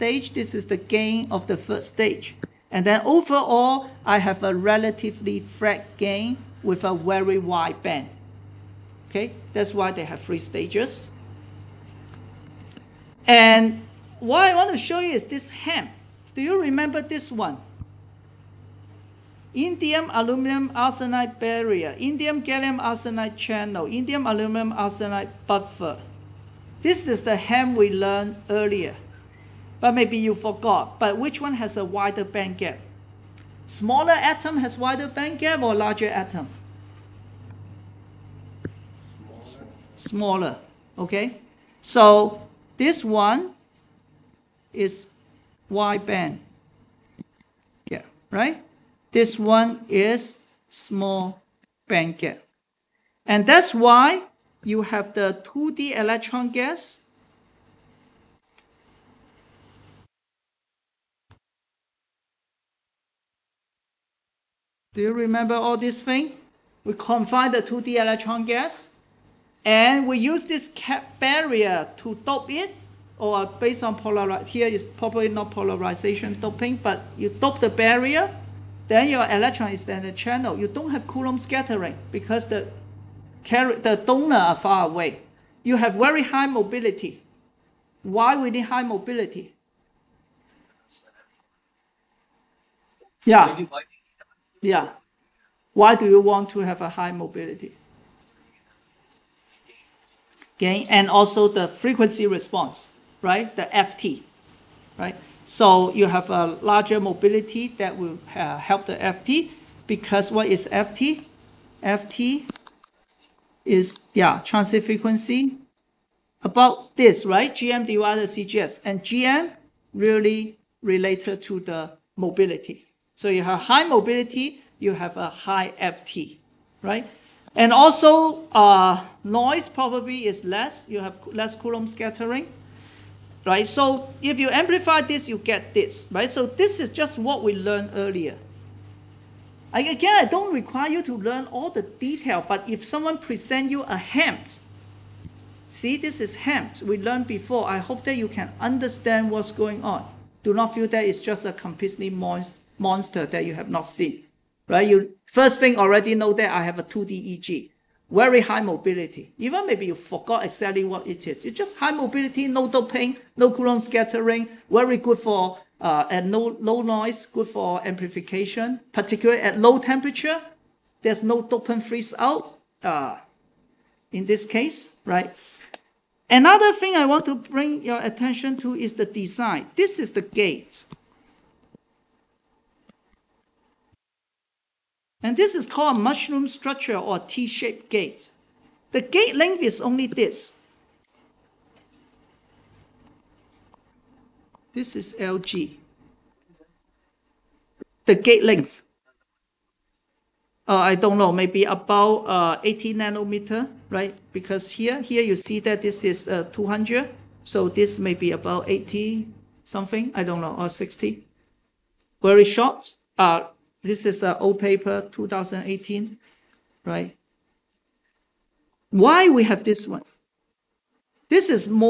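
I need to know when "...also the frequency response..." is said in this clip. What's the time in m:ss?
1:41.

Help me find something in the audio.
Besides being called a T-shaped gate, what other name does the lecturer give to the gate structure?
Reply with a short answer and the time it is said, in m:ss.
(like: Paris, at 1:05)
mushroom structure, at 3:05.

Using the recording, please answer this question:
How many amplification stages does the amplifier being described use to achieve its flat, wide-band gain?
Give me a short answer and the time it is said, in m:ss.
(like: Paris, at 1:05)
3, at 0:10.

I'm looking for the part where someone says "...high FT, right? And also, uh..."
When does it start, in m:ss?
2:05.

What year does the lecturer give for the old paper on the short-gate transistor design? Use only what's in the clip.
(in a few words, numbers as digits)
2018.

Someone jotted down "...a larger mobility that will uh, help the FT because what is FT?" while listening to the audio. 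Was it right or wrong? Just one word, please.
right.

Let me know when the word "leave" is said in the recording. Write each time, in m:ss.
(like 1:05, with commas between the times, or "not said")
not said.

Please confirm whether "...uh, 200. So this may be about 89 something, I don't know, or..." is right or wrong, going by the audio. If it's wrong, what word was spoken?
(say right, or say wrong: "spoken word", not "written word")
wrong: "80", not "89".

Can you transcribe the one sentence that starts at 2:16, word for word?
So this is just what we learned earlier.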